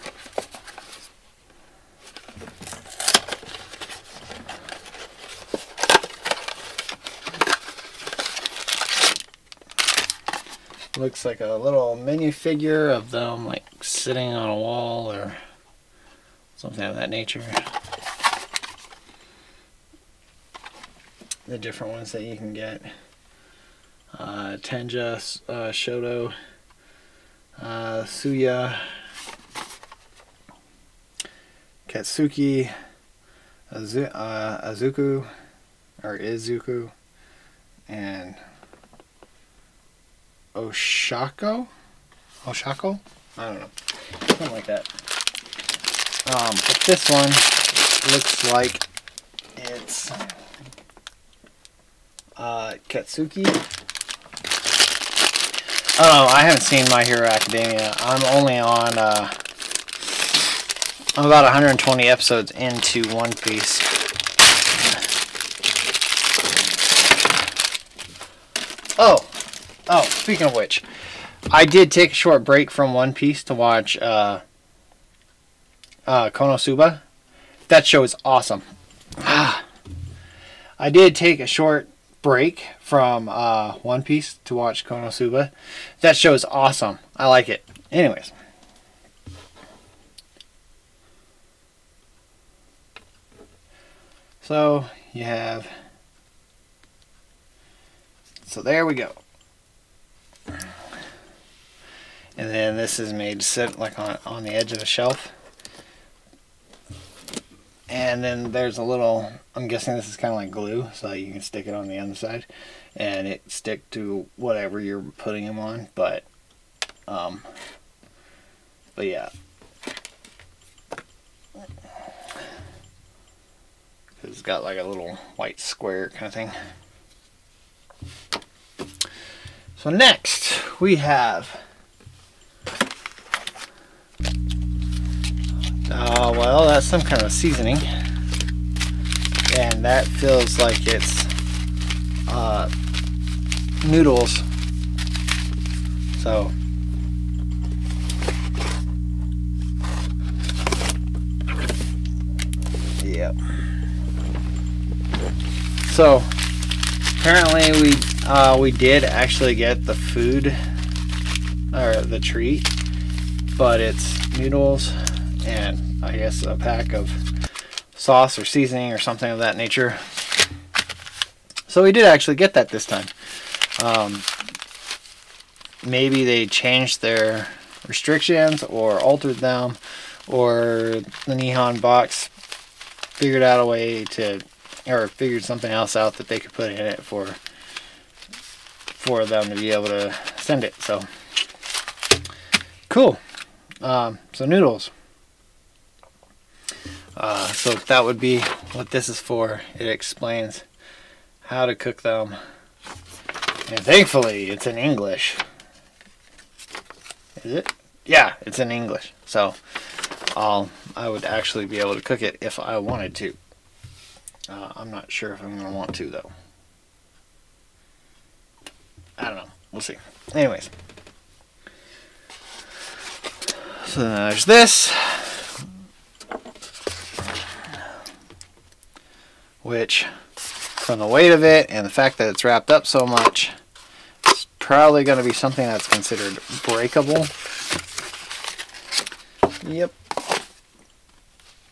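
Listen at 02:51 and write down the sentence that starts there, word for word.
So we did actually get that this time.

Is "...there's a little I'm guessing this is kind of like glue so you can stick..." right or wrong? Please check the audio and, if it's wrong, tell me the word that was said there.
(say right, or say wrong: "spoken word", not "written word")
right.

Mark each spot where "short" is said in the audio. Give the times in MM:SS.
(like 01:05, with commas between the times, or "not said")
01:12, 01:21.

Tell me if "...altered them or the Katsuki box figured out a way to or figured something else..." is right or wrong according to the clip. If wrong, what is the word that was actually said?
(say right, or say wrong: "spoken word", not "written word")
wrong: "Nihon", not "Katsuki".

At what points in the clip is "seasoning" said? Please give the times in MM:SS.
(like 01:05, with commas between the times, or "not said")
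02:17, 02:48.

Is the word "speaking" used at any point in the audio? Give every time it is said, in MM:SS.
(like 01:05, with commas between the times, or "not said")
01:10.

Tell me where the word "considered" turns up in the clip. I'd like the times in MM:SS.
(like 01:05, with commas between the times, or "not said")
03:55.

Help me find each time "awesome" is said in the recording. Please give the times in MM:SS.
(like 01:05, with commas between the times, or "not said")
01:18, 01:26.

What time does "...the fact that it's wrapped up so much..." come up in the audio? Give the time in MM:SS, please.
03:51.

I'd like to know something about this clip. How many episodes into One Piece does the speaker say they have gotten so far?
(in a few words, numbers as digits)
120.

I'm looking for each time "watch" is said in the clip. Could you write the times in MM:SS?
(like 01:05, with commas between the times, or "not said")
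01:13, 01:24.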